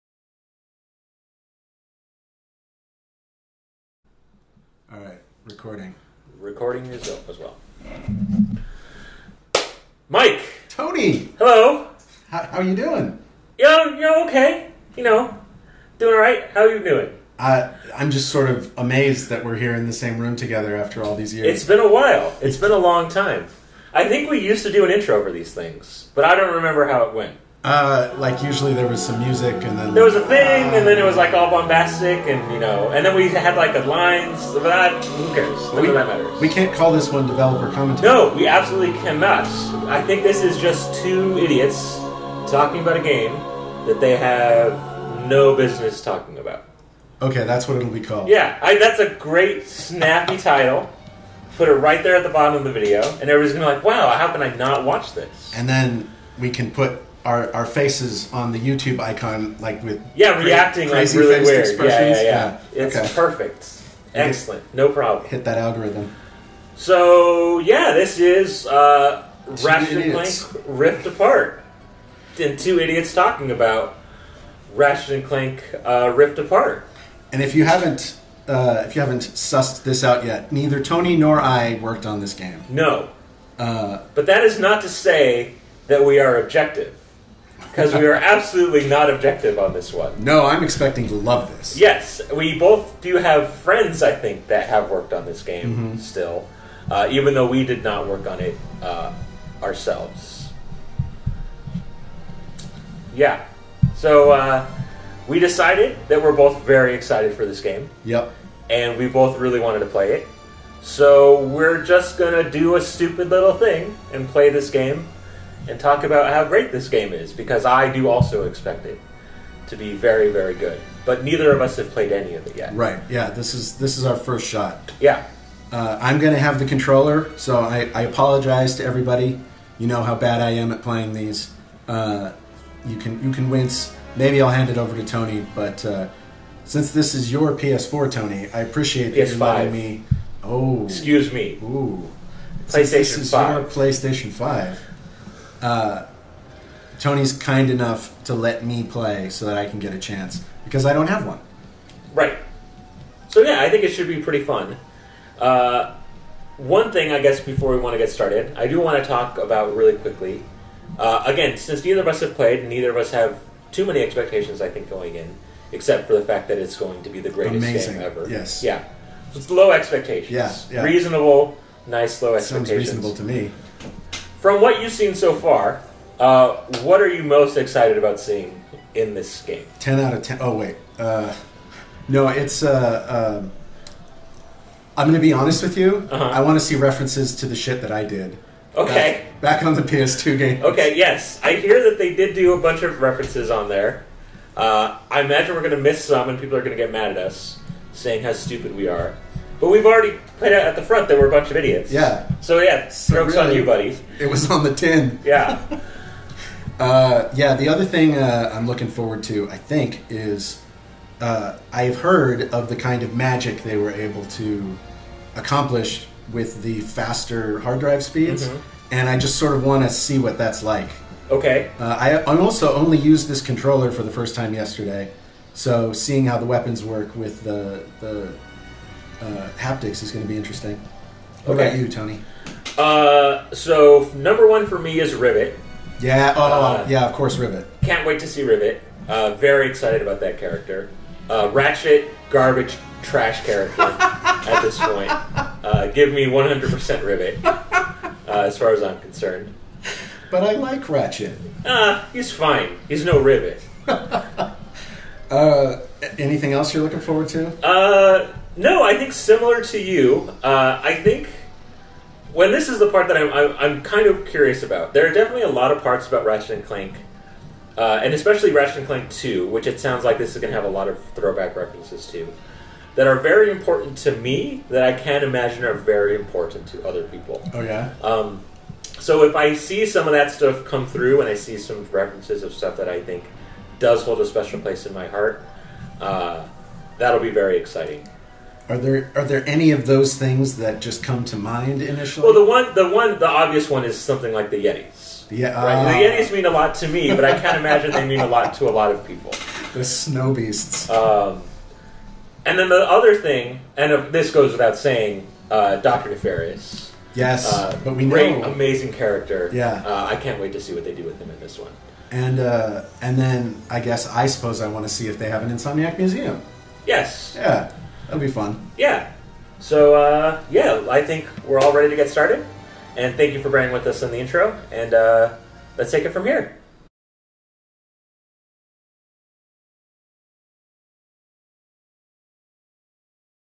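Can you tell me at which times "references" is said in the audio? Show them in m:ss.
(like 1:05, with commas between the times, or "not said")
3:06, 3:12, 4:31, 4:41.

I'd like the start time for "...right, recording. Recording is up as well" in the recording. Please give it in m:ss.
0:04.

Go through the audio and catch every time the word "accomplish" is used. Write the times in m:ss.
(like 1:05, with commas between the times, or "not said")
3:35.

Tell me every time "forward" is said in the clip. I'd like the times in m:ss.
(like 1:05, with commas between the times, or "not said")
3:28, 4:17.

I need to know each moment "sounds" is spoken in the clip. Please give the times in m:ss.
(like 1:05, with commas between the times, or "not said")
2:52, 4:29.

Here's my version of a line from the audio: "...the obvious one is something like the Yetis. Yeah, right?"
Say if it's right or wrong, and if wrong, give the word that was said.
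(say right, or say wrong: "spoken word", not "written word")
right.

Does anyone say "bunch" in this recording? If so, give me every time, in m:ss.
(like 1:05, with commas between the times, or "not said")
3:12, 3:21.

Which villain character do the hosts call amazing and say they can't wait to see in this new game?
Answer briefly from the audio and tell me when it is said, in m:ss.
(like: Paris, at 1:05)
Doctor Nefarious, at 5:05.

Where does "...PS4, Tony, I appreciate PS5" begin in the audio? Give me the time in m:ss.
2:17.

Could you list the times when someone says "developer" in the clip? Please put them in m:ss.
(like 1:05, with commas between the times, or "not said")
0:37.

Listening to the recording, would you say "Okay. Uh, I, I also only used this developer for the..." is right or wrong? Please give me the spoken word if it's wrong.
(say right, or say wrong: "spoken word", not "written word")
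wrong: "controller", not "developer".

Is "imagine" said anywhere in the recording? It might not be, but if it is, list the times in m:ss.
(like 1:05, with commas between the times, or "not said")
3:15, 4:35, 4:57.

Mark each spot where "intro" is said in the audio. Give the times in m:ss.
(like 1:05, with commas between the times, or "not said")
0:24, 5:24.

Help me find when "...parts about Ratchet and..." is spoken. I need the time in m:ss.
4:25.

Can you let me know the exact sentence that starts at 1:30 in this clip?
No, I'm expecting to love this.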